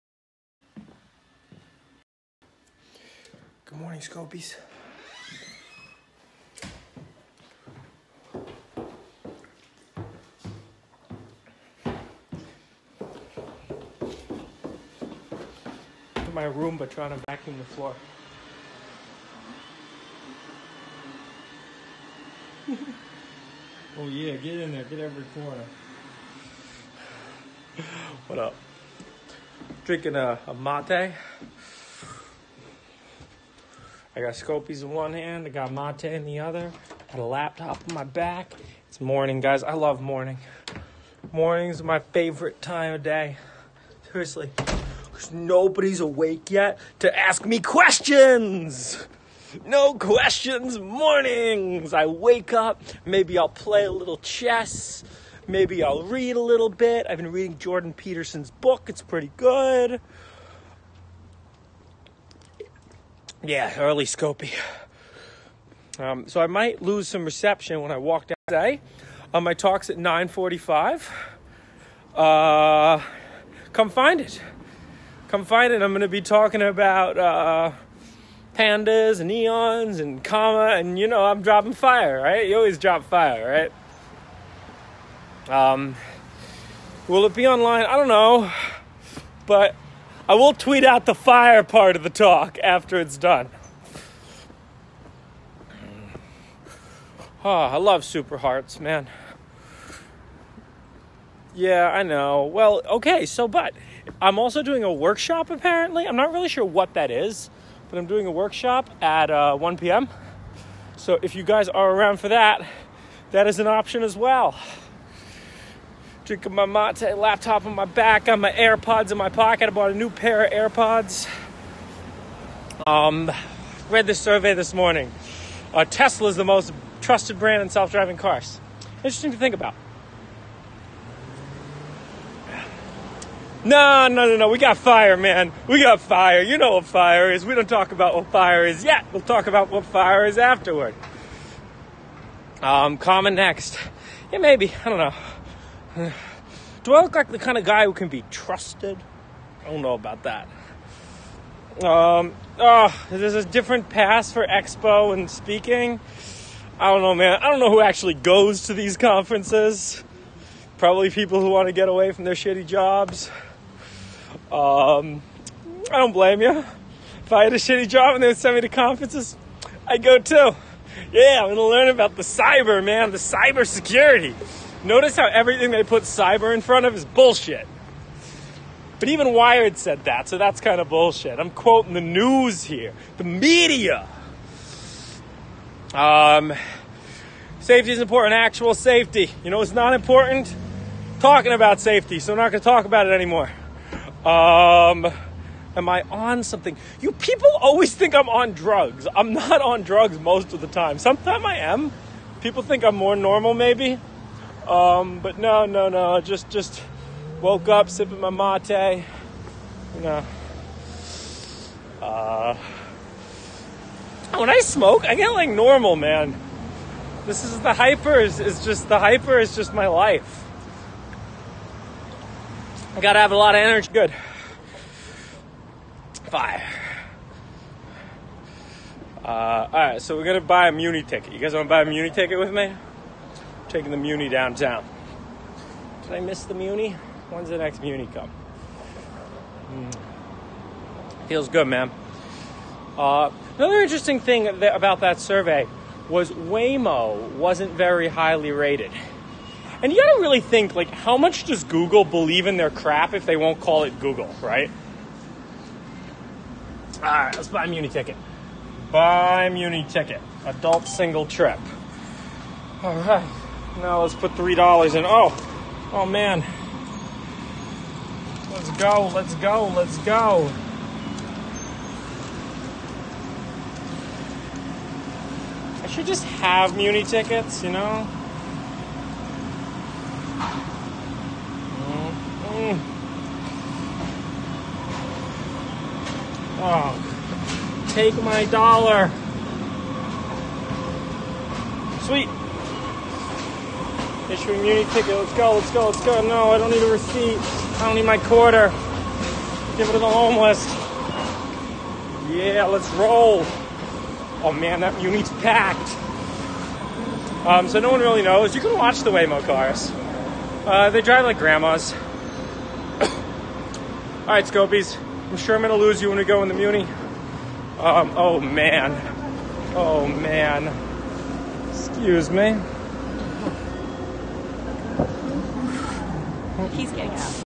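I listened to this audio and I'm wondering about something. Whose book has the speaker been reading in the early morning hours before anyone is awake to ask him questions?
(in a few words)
Jordan Peterson.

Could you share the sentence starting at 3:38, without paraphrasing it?
Is, is just the hyper is just my life.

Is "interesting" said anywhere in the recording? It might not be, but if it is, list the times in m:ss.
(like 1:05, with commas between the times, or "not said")
2:08, 4:03.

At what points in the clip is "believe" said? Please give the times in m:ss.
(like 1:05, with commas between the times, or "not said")
4:12.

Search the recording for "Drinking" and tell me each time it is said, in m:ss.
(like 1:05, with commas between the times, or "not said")
0:29, 1:56.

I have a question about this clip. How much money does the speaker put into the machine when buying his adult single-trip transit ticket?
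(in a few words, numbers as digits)
$3.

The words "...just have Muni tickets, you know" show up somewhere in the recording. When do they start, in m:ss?
4:36.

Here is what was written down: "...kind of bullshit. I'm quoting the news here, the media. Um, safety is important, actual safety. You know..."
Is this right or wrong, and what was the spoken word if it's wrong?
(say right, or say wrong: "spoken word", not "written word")
right.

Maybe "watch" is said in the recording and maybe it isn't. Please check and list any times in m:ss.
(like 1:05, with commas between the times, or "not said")
5:08.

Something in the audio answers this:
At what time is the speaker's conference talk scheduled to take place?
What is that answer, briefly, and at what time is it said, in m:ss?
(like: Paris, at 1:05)
9:45, at 1:09.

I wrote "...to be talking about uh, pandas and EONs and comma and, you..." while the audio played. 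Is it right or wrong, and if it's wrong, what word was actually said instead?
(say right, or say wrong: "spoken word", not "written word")
right.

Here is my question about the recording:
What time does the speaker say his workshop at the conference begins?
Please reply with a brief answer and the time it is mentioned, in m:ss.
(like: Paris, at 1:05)
1 p.m., at 1:49.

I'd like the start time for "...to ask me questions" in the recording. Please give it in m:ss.
0:46.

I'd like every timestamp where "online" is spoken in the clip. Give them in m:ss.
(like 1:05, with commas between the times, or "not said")
1:27.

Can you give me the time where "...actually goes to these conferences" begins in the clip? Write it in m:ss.
2:37.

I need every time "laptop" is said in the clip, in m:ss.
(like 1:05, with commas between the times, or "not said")
0:37, 1:57.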